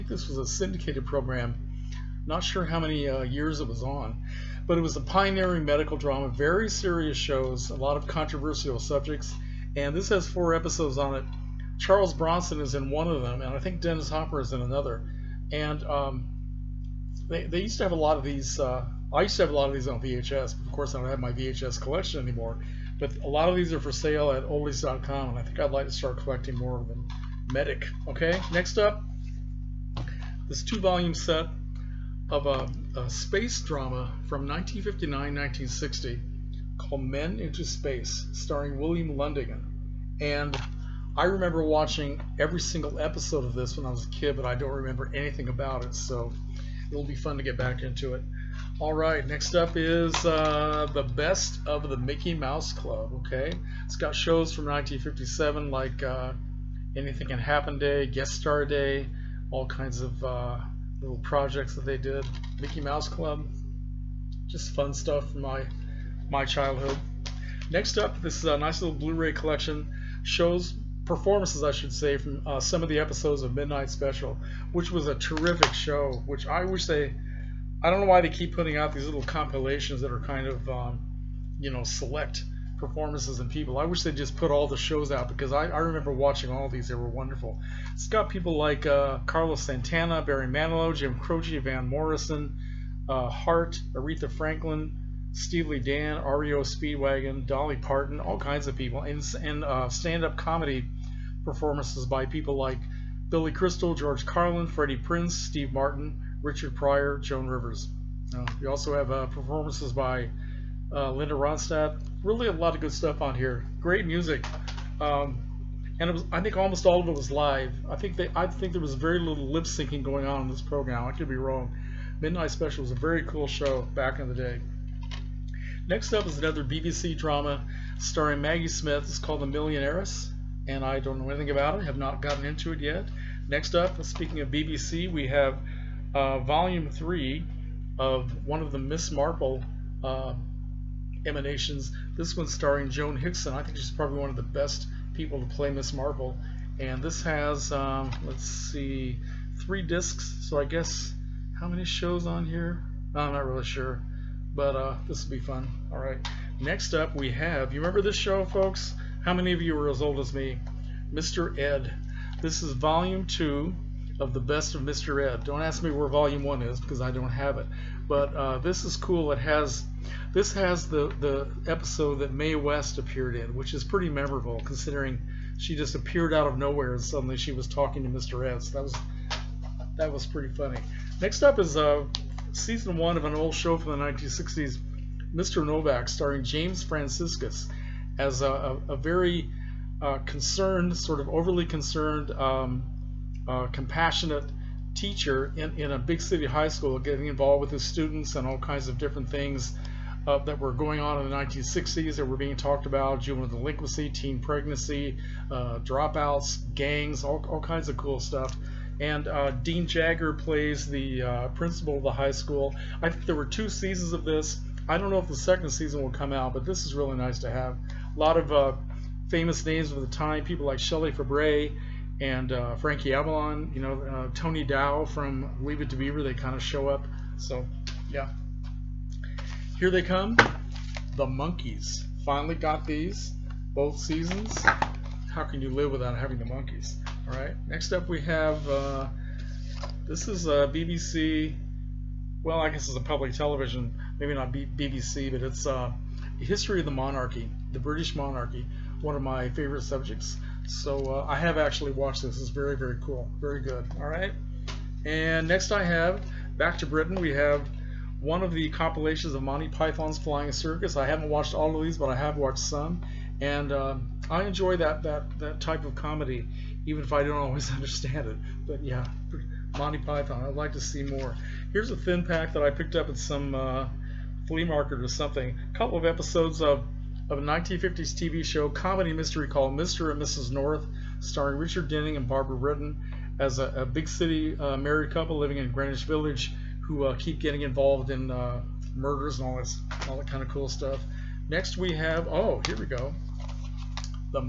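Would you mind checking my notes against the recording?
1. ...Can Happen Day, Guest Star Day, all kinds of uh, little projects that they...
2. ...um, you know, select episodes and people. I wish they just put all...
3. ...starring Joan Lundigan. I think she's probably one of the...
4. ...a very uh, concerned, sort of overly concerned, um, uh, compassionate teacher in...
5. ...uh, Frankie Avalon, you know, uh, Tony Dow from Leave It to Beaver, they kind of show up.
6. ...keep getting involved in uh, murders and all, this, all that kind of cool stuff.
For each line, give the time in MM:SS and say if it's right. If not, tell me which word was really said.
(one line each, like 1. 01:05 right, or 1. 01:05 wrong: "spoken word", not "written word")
1. 00:57 right
2. 01:20 wrong: "performances", not "episodes"
3. 02:22 wrong: "Hickson", not "Lundigan"
4. 03:08 right
5. 03:42 right
6. 04:47 right.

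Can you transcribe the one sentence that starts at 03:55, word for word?
How can you live without having the Monkees?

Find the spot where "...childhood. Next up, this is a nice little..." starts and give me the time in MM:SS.
01:06.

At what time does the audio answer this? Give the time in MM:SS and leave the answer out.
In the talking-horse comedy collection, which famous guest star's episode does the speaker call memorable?
02:52.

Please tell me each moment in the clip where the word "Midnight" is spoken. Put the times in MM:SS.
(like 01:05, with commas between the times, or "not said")
01:13, 02:02.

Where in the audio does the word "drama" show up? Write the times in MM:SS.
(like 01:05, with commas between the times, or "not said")
00:05, 00:33, 02:07.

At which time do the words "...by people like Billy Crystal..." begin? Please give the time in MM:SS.
01:42.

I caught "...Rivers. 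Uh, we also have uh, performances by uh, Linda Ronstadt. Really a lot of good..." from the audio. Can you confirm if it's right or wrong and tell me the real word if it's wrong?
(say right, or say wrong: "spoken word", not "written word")
right.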